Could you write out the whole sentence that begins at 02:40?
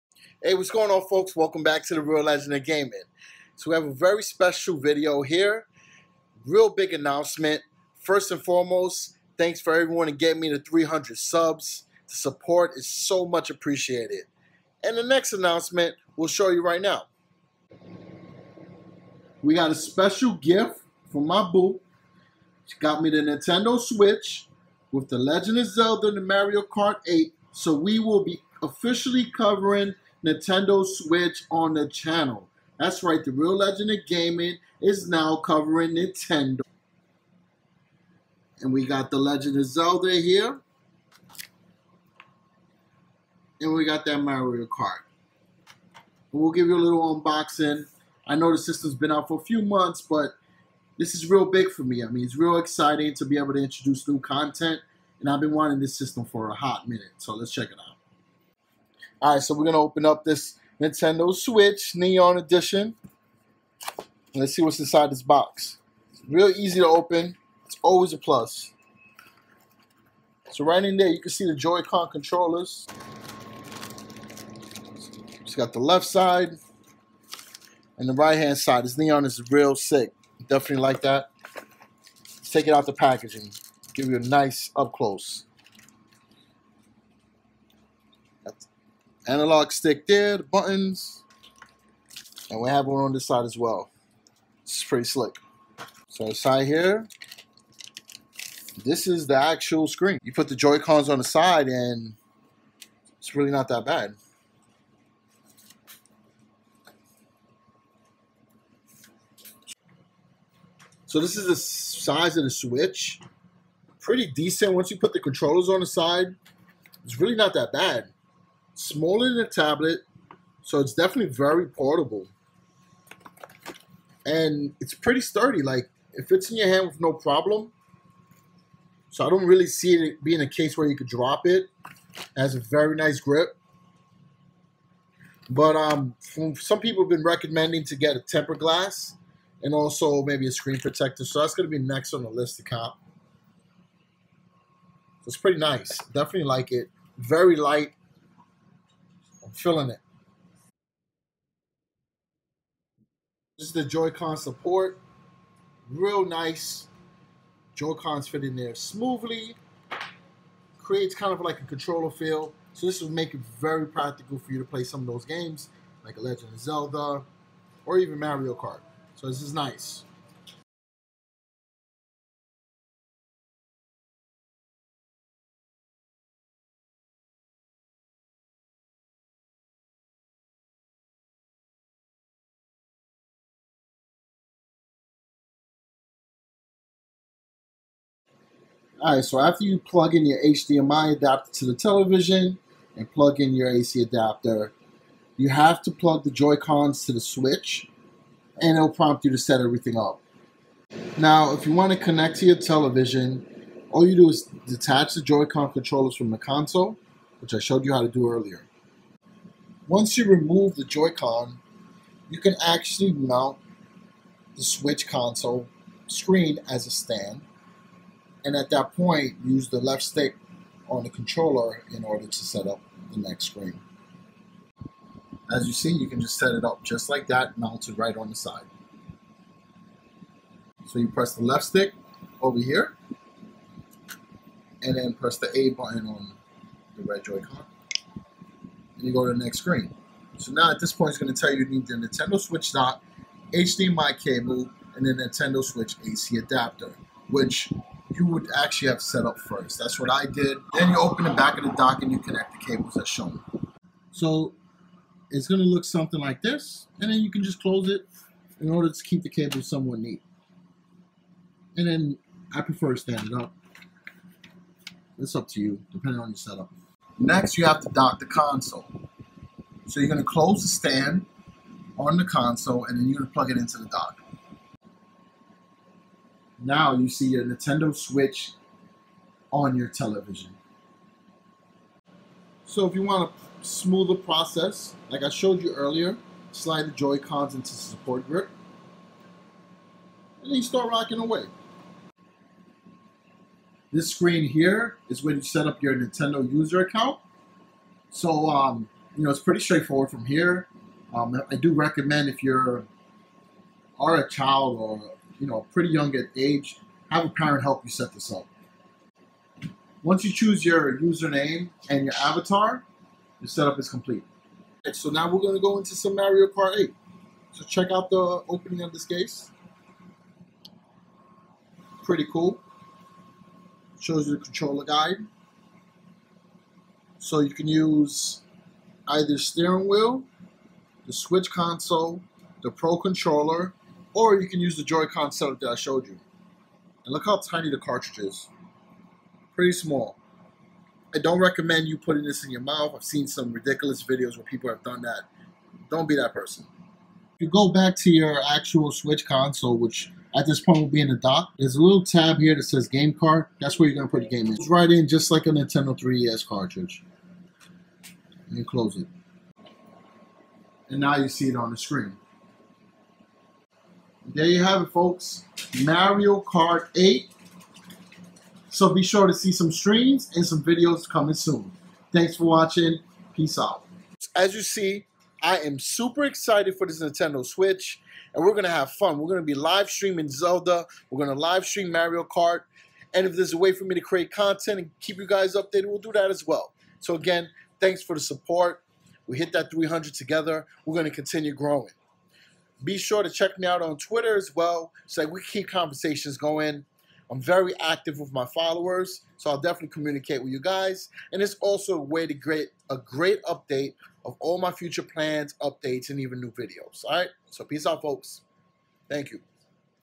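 Creates kind of like a controller feel.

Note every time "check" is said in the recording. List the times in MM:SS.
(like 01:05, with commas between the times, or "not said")
00:57, 05:17, 06:33.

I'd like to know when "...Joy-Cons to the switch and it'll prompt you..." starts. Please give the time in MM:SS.
03:16.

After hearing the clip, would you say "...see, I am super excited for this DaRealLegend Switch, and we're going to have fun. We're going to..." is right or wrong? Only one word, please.
wrong.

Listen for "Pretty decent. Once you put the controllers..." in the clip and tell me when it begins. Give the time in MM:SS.
01:53.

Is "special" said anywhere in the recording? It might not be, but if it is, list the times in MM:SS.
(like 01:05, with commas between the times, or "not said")
00:04, 00:19.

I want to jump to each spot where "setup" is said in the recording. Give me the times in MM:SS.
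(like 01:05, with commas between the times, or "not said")
04:26, 05:13, 05:35.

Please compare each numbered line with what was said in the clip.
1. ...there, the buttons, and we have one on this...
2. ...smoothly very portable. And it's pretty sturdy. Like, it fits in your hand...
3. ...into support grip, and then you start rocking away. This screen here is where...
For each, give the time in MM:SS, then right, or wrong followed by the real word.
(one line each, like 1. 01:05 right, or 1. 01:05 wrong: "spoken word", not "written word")
1. 01:30 right
2. 02:00 wrong: "definitely", not "smoothly"
3. 04:47 right.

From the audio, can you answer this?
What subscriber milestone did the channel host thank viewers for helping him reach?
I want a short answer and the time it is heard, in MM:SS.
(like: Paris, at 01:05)
300, at 00:10.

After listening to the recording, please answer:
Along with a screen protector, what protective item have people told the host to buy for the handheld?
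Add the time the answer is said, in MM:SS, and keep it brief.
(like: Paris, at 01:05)
Tempered glass, at 02:18.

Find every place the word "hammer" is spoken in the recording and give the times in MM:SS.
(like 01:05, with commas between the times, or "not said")
not said.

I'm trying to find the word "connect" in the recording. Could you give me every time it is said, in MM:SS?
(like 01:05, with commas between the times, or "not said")
03:21, 04:12.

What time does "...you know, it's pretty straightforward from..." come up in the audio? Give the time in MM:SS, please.
04:59.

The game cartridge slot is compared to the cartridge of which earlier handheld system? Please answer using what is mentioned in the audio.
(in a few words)
Nintendo 3DS.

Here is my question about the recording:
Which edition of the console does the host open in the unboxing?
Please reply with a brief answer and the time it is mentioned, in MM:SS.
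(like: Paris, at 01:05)
Neon Edition, at 01:01.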